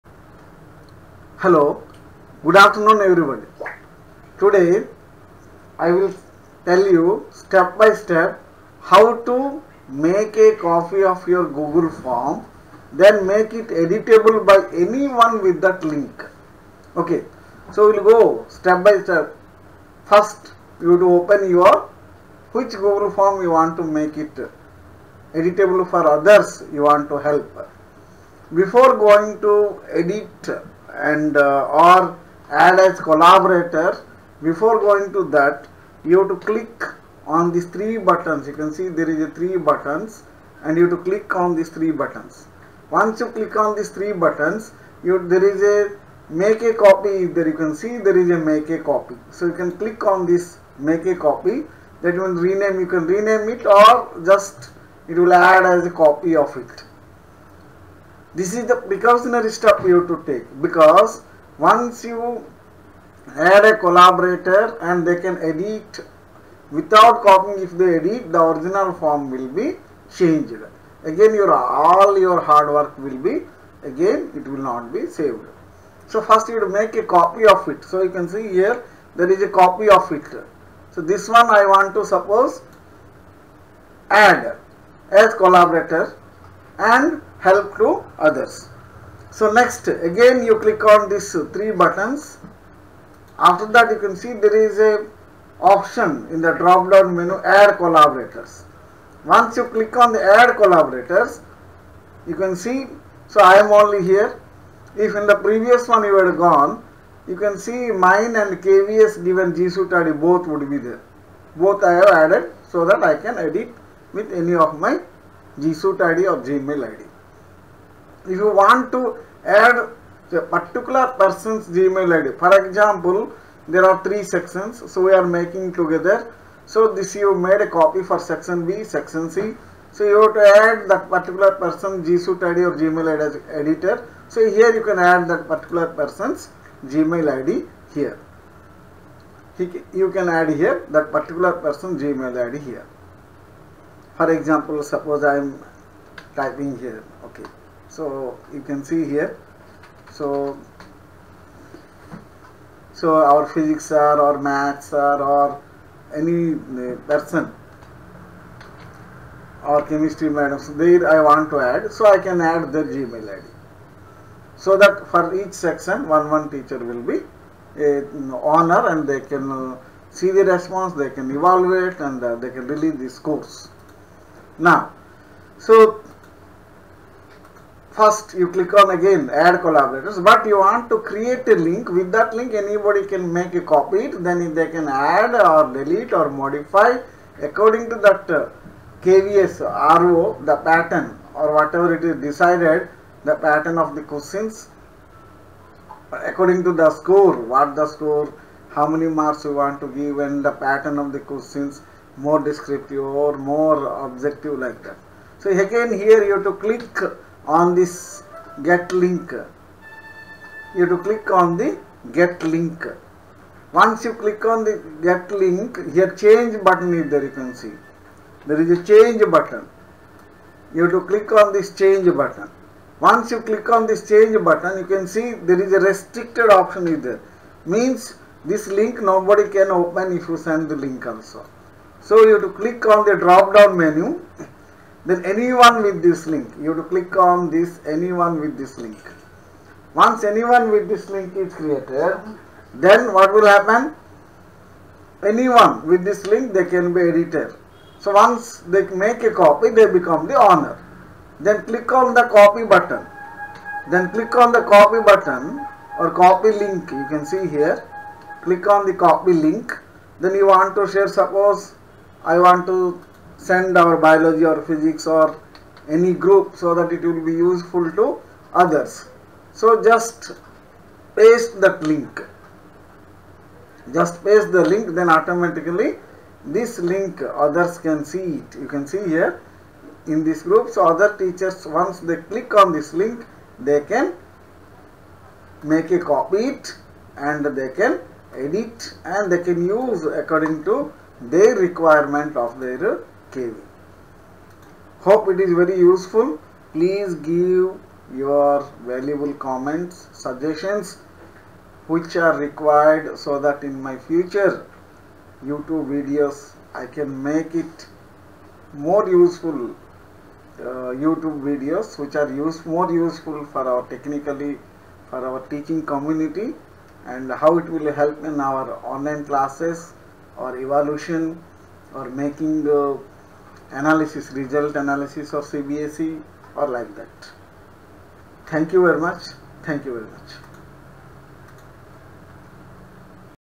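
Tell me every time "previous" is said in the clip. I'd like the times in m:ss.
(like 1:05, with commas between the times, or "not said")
1:45.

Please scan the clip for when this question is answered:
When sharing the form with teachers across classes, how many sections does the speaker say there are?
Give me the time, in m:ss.
2:04.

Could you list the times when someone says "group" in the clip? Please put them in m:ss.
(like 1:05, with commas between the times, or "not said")
4:26, 4:40.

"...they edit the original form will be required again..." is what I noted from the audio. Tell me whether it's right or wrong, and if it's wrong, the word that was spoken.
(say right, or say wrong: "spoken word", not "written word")
wrong: "changed", not "required".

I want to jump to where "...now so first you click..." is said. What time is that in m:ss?
2:54.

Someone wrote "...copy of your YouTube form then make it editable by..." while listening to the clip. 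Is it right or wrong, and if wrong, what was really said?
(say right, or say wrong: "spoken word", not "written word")
wrong: "Google", not "YouTube".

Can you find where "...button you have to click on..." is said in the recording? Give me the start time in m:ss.
3:39.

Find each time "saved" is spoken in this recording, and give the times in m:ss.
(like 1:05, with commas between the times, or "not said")
1:15.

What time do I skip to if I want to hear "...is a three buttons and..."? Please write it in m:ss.
0:39.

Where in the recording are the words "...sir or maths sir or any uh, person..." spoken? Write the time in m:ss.
2:33.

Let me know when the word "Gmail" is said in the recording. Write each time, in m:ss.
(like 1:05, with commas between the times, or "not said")
1:56, 2:01, 2:12, 2:16, 2:21, 2:42.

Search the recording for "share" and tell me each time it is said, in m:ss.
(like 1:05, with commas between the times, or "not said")
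4:20.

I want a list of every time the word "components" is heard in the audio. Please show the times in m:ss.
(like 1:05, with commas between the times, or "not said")
not said.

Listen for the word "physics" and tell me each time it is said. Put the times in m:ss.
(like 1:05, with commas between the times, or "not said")
2:33, 4:24.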